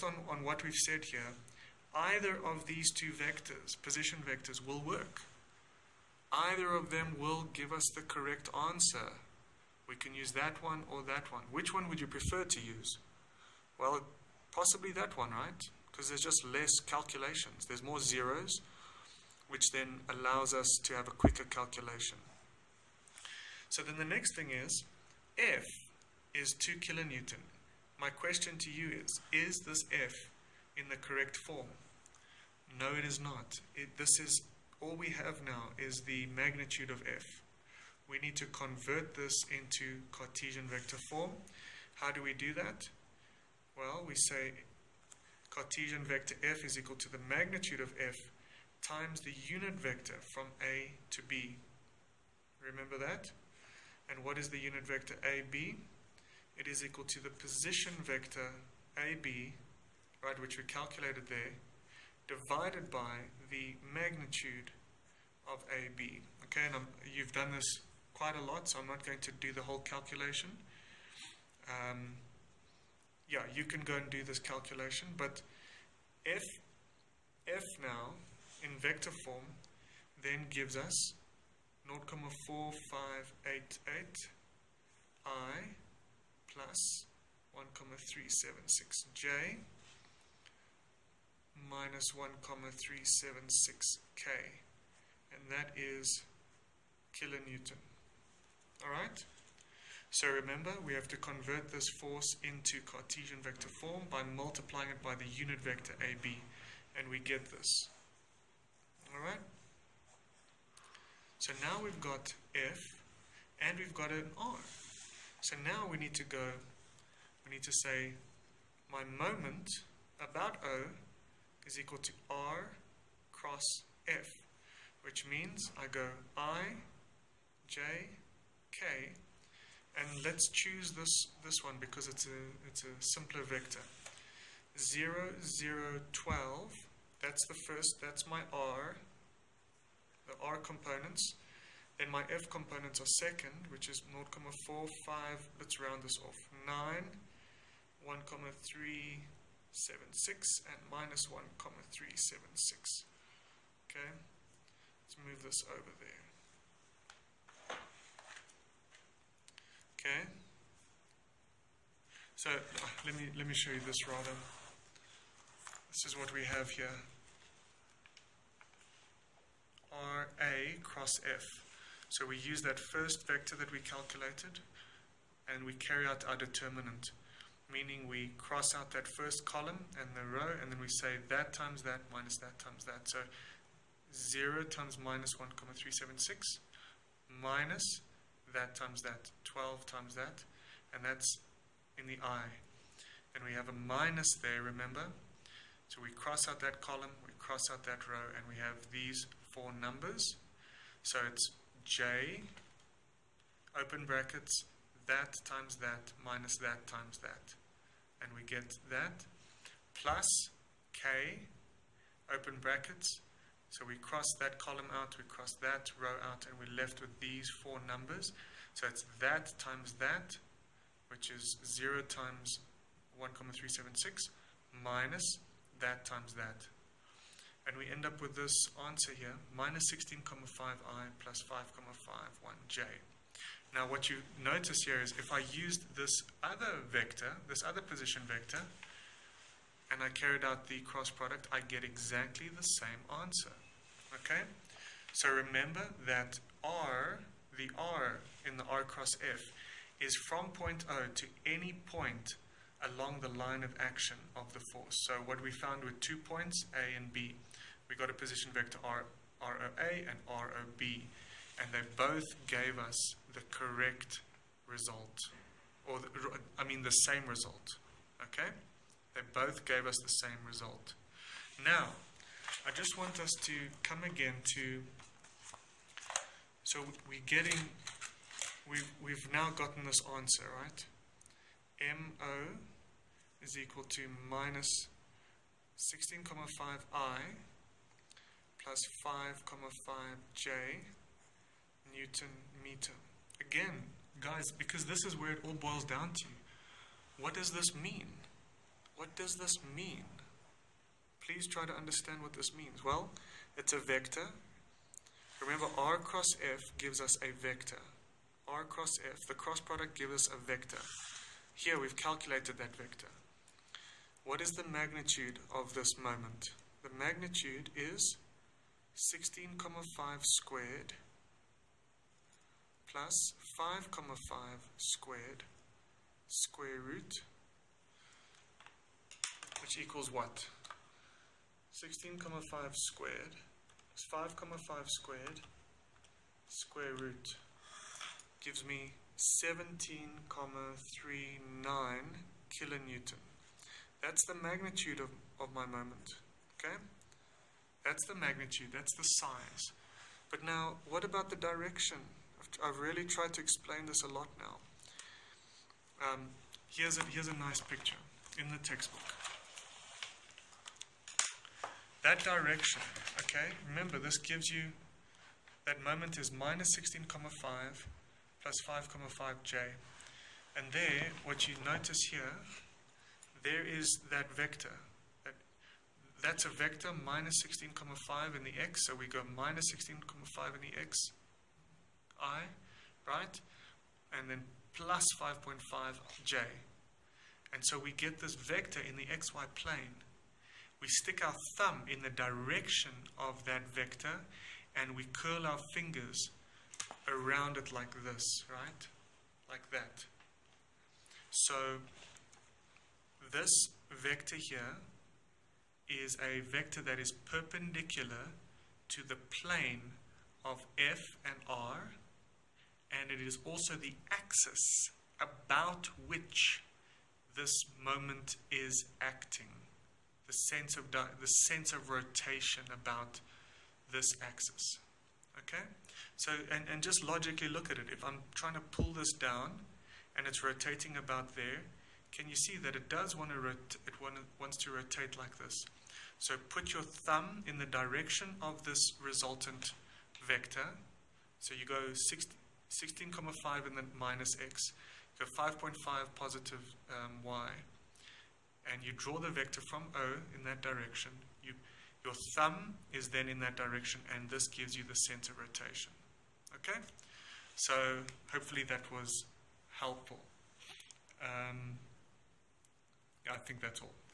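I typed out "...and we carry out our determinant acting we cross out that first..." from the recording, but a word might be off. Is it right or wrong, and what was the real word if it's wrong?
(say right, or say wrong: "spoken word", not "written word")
wrong: "meaning", not "acting".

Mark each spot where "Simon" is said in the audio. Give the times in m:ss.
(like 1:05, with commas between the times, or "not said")
not said.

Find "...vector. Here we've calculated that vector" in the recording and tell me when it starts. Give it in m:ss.
5:10.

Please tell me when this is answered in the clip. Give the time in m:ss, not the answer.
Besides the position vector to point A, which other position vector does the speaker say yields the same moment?
4:20.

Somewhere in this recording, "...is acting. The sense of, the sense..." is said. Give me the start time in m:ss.
6:58.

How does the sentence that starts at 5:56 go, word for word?
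Um, here's, a, here's a nice picture in the textbook.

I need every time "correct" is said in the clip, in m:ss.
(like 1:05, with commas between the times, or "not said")
0:08, 0:30, 4:23.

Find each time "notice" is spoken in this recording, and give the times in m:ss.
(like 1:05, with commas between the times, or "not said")
3:54, 6:11.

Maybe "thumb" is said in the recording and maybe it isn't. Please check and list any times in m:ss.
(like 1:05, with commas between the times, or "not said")
6:31, 7:16, 7:32.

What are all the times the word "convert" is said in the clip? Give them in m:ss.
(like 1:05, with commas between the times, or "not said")
0:38, 1:41.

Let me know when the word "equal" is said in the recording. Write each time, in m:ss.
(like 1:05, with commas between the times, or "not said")
0:46, 0:56, 2:01, 4:43, 5:29.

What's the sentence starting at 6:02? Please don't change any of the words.
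That direction, okay, remember this gives you, that moment is minus 16,5 plus 5,5j.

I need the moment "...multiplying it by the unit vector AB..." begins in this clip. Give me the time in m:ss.
1:44.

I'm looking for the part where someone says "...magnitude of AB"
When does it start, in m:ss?
1:03.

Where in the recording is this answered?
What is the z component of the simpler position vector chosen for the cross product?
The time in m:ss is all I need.
2:14.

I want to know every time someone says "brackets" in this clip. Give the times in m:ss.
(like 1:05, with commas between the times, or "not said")
3:24, 3:32.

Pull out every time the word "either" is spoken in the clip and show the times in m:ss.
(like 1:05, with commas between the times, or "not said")
0:01, 0:06.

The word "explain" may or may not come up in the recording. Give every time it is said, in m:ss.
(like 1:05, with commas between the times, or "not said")
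5:53.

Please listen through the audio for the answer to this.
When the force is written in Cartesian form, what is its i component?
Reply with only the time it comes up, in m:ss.
1:21.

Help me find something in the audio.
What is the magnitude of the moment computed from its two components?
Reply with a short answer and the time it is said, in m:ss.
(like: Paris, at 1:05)
17.39, at 5:39.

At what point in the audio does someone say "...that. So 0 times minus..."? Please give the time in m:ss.
3:02.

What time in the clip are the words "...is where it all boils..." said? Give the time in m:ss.
4:55.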